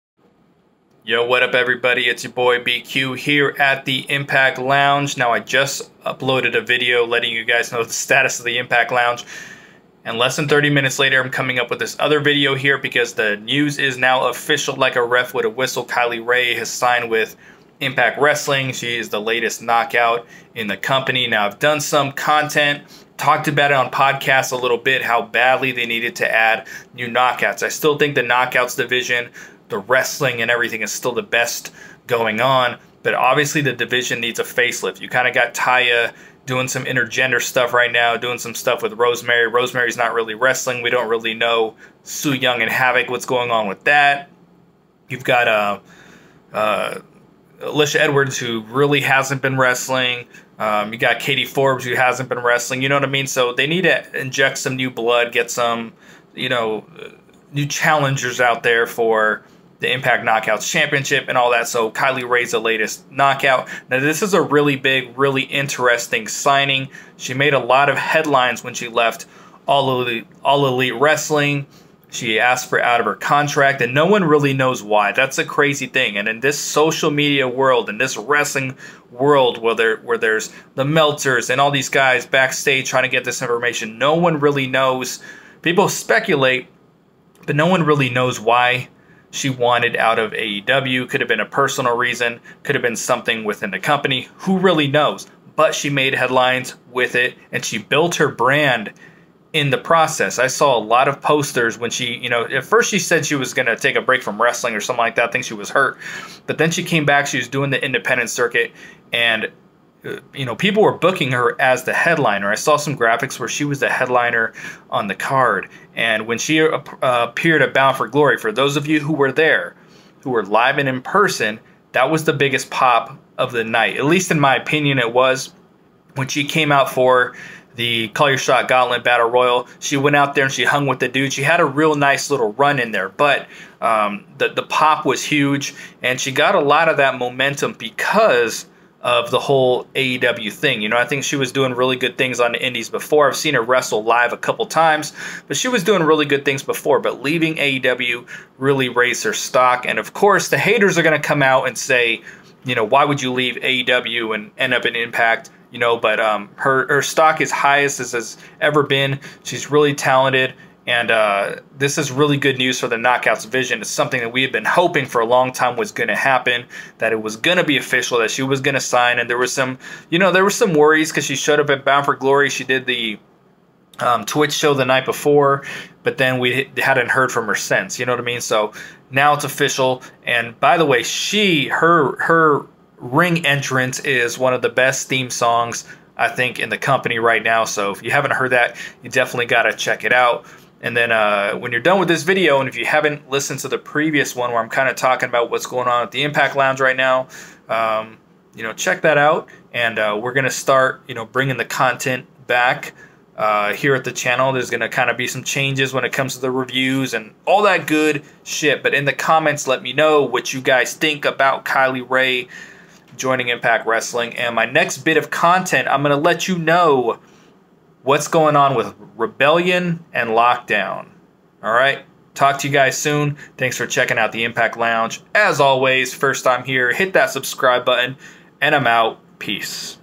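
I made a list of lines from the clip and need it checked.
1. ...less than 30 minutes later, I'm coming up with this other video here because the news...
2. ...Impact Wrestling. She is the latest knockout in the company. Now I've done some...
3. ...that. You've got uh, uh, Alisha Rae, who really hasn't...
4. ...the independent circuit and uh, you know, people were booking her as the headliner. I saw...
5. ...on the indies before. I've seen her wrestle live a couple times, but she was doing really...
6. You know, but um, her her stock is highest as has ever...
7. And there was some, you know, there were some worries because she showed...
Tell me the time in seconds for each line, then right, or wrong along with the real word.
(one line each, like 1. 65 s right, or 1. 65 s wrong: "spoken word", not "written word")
1. 10 s right
2. 17 s right
3. 43 s wrong: "Edwards", not "Rae"
4. 107 s right
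5. 142 s right
6. 155 s right
7. 169 s right.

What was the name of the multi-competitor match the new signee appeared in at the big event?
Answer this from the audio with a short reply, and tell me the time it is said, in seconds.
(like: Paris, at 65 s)
Call Your Shot Gauntlet Battle Royal, at 128 s.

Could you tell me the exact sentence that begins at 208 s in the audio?
But in the comments, let me know what you guys think about Kylie Rae joining Impact Wrestling.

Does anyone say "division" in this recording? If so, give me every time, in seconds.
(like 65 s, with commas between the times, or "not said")
28 s, 33 s.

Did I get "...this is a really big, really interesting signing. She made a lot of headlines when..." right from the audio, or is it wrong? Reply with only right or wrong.
right.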